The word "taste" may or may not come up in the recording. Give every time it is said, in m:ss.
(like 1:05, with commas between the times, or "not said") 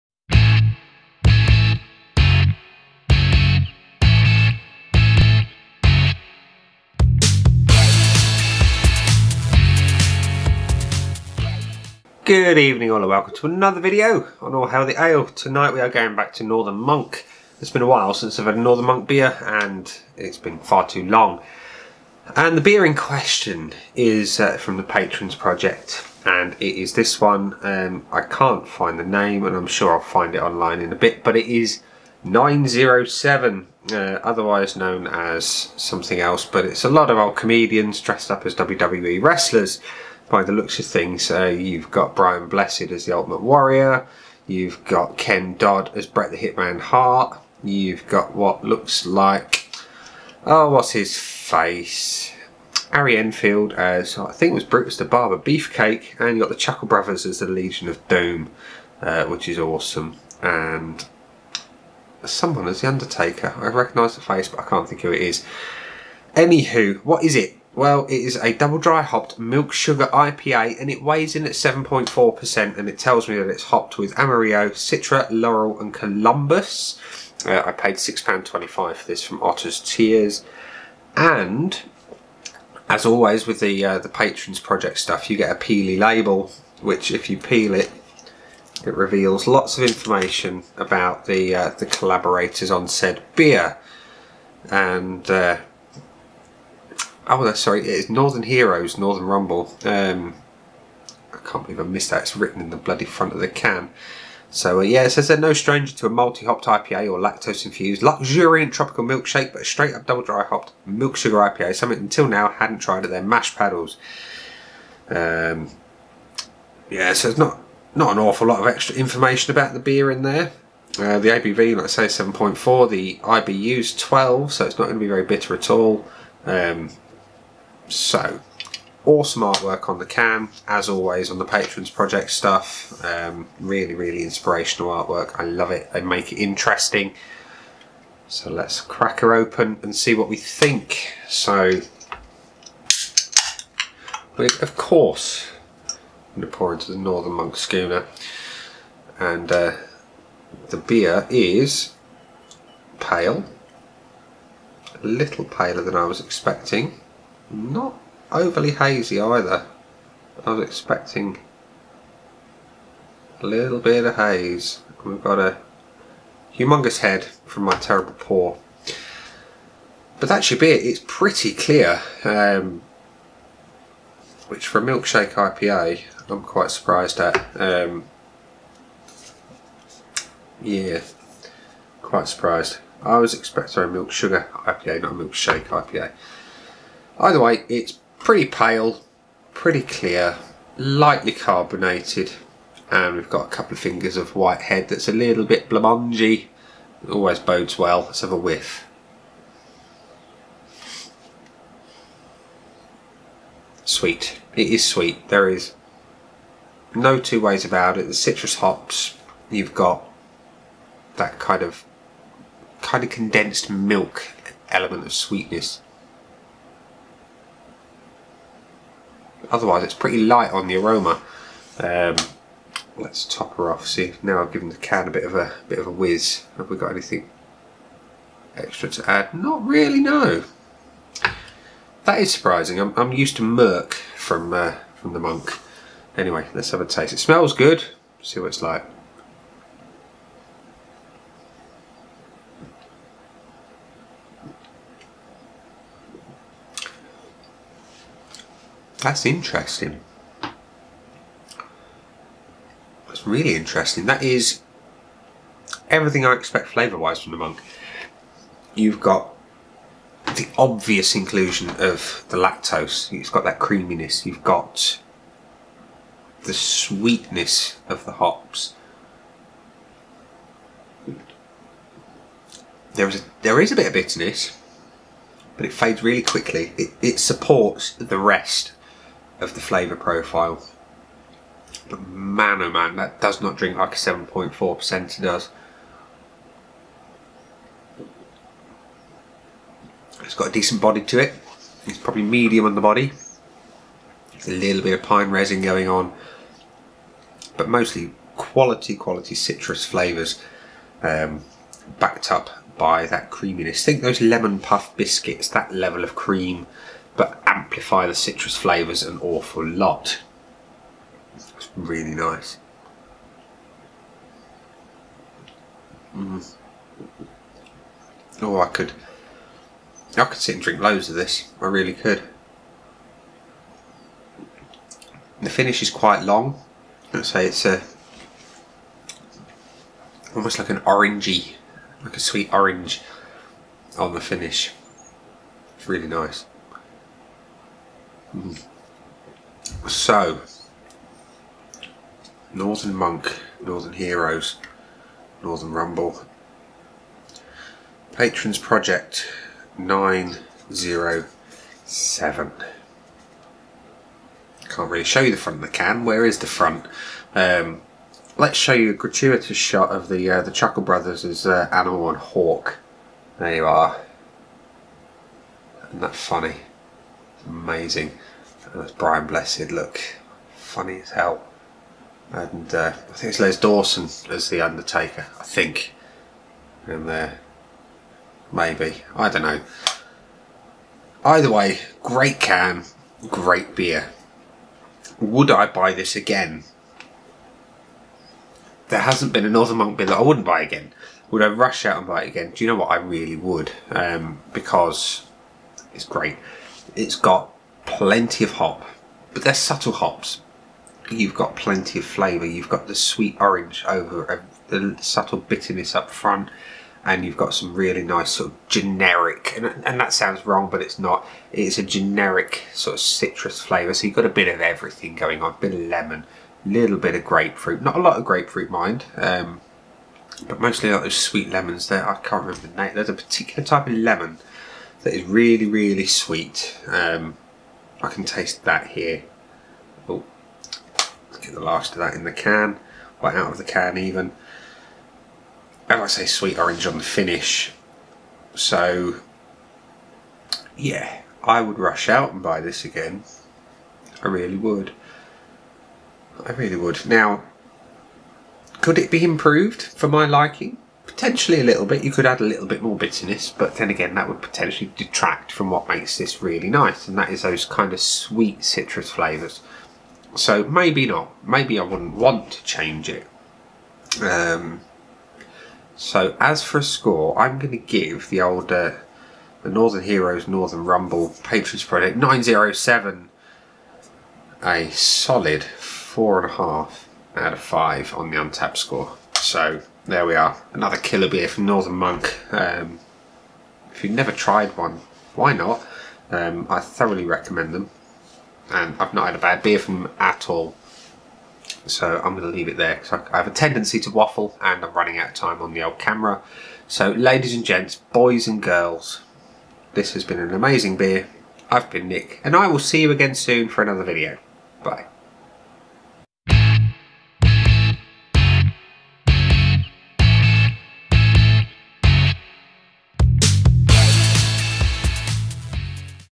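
3:56, 7:08.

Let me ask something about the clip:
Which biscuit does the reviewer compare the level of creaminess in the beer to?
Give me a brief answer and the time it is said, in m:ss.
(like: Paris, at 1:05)
Lemon puff biscuits, at 5:04.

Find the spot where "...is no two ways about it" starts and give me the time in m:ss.
3:25.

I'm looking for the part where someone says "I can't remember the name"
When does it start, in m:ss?
7:02.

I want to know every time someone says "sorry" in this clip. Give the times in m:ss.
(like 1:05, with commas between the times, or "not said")
1:37.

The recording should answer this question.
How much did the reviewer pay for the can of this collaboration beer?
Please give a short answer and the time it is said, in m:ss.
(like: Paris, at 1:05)
£6.25, at 1:17.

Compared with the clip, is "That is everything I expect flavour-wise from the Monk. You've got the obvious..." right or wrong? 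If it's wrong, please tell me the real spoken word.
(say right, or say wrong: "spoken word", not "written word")
right.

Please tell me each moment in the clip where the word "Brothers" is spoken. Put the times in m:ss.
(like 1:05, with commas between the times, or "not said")
0:56, 6:00.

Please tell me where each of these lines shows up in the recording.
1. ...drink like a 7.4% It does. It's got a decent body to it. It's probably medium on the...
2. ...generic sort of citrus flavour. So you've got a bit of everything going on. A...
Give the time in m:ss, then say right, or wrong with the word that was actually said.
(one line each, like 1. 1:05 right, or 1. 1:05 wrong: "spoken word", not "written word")
1. 4:43 right
2. 6:51 right.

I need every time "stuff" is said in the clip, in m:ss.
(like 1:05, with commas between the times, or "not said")
1:24, 2:12.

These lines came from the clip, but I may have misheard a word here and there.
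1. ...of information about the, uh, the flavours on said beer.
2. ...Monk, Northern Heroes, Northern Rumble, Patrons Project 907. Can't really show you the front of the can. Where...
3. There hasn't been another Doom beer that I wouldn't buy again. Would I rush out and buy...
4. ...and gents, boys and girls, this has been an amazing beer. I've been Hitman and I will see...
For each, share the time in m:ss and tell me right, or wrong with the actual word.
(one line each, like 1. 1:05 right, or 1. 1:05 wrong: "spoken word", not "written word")
1. 1:29 wrong: "collaborators", not "flavours"
2. 5:42 right
3. 6:28 wrong: "Monk", not "Doom"
4. 8:17 wrong: "Nick", not "Hitman".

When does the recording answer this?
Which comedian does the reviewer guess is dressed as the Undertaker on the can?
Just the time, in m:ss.
6:13.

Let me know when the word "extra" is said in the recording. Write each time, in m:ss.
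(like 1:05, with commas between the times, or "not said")
1:58, 3:48.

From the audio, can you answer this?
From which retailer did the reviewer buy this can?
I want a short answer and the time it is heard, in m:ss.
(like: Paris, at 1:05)
Otter's Tears, at 1:19.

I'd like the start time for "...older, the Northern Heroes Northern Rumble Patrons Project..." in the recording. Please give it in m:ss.
7:48.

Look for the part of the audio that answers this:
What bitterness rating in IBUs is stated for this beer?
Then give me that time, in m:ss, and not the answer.
2:03.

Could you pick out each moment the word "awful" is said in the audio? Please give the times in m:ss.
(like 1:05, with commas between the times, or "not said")
1:58, 5:09.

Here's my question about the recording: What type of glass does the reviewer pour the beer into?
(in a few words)
Northern Monk Schooner.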